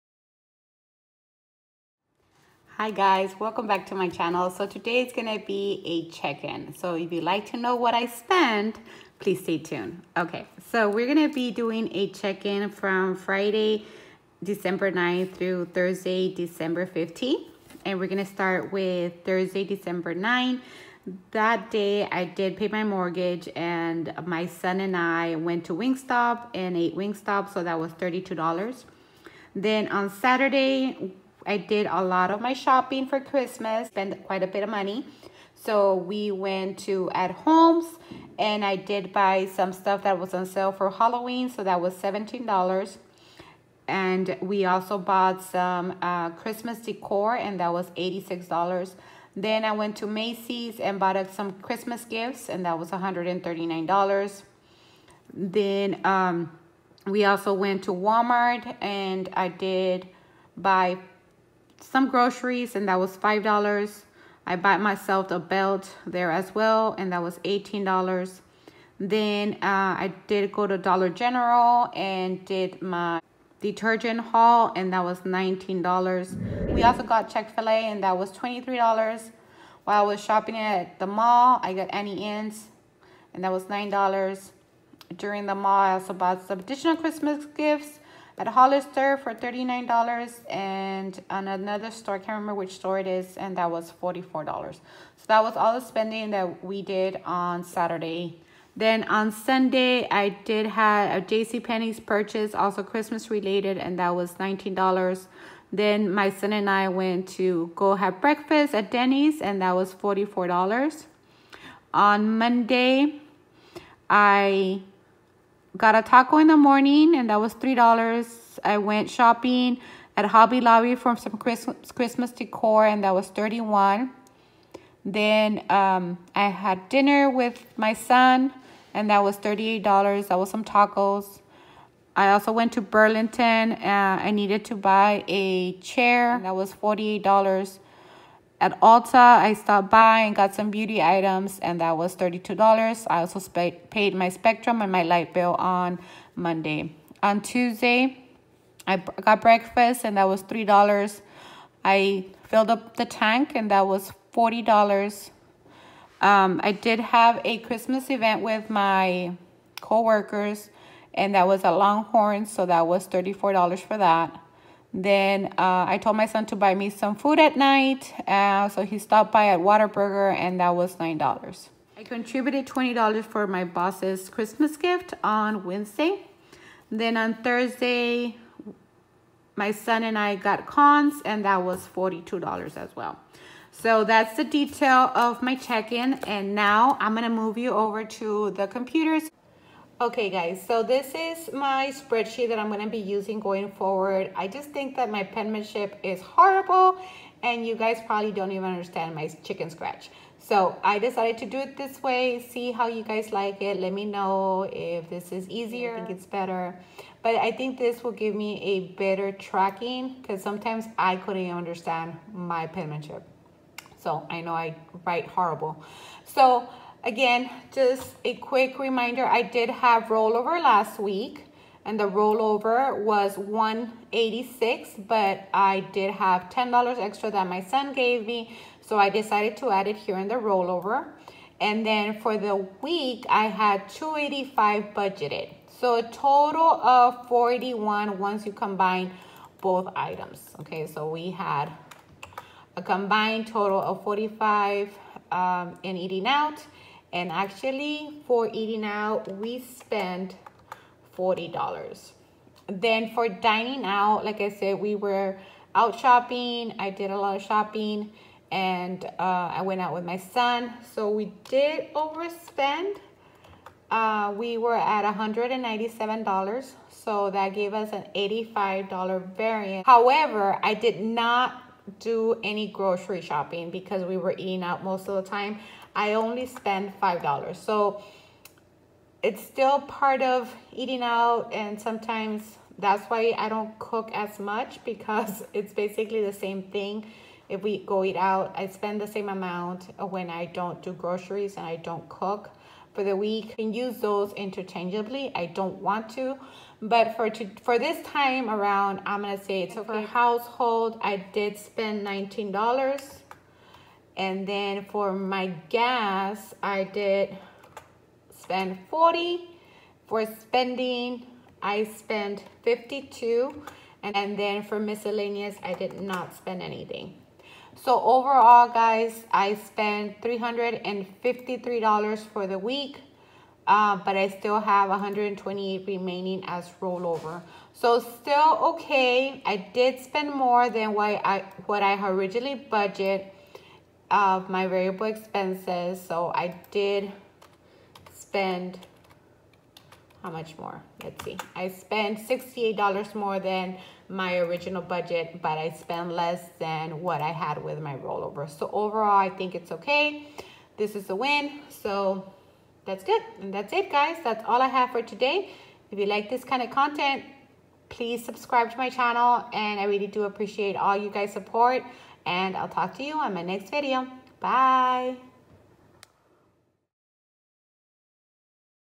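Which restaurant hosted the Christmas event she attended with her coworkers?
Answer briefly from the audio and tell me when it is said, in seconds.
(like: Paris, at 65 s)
Longhorn, at 161 s.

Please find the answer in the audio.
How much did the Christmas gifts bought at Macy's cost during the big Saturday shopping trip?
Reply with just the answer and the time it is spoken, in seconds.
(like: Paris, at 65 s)
$139, at 52 s.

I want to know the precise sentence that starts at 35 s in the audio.
So we went to At Homes and I did buy some stuff that was on sale for Halloween.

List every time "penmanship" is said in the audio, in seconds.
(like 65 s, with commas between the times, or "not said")
195 s, 212 s.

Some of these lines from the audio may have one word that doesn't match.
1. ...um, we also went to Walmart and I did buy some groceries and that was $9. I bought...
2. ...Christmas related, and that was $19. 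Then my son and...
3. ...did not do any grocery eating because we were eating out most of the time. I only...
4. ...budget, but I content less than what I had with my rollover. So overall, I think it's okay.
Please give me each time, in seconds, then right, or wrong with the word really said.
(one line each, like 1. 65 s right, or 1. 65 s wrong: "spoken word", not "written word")
1. 56 s wrong: "5", not "9"
2. 102 s right
3. 270 s wrong: "shopping", not "eating"
4. 344 s wrong: "spent", not "content".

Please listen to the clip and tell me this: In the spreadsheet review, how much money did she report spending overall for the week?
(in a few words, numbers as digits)
$353.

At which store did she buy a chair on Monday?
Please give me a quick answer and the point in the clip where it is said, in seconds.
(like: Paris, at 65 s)
Burlington, at 132 s.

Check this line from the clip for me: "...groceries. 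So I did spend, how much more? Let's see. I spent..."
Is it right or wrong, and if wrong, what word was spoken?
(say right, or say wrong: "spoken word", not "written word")
wrong: "expenses", not "groceries".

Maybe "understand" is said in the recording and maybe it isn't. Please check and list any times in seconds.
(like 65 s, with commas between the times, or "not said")
198 s, 211 s.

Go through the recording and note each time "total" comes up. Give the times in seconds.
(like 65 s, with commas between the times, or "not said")
236 s, 243 s.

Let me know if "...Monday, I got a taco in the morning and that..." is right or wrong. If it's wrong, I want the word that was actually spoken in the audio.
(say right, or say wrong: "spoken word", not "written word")
right.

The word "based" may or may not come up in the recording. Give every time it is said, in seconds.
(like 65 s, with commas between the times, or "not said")
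not said.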